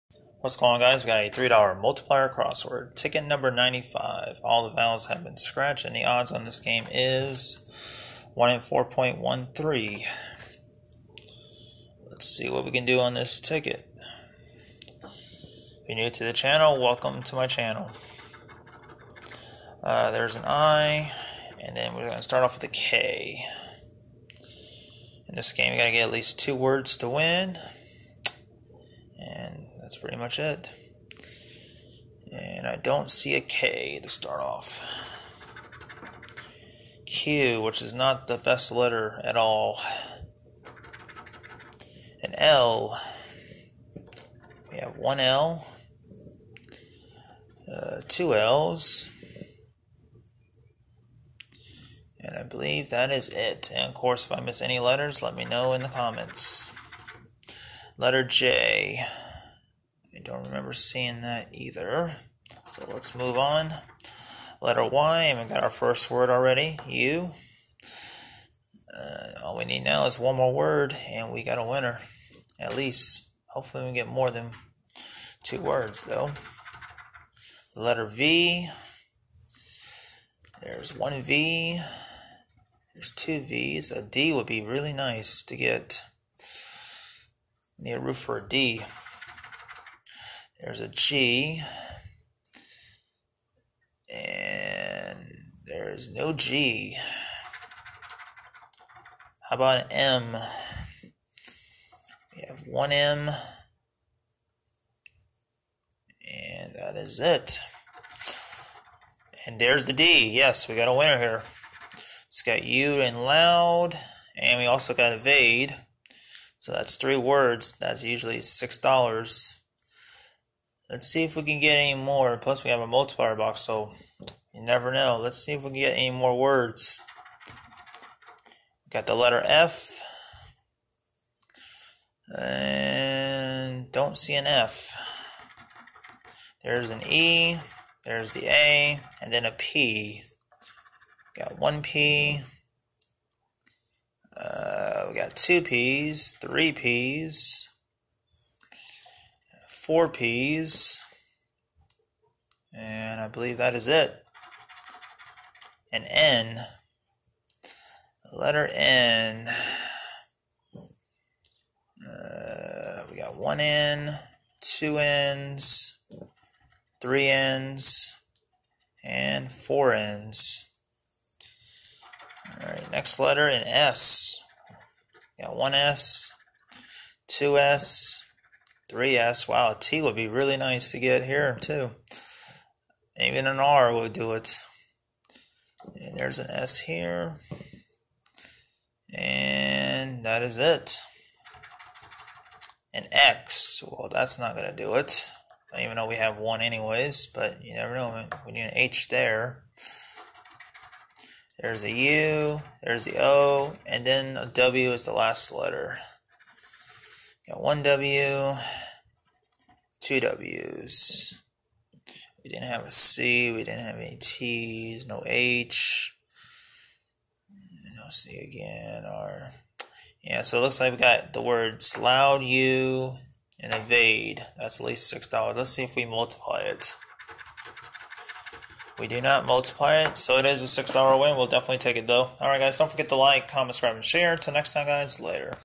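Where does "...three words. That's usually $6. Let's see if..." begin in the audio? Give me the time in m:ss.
1:56.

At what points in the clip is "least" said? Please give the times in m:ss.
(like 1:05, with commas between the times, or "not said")
0:26, 1:12, 3:44.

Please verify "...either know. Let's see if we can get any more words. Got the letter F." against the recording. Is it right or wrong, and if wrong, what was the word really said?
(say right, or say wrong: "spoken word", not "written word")
wrong: "never", not "either".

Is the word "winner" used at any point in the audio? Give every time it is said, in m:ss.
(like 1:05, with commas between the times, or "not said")
1:11, 1:50.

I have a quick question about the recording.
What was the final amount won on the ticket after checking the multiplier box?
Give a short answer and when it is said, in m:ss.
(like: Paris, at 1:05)
$6, at 3:50.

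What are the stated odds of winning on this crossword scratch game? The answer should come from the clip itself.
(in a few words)
1 in 4.13.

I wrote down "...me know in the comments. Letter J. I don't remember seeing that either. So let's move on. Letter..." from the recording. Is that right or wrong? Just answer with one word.
right.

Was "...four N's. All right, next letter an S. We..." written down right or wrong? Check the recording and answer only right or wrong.
right.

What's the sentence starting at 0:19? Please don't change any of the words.
Uh, there's an I, and then we're going to start off with a K.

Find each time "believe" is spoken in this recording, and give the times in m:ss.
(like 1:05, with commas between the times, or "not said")
0:52, 2:33.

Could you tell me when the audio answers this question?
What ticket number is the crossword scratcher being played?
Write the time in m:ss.
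0:03.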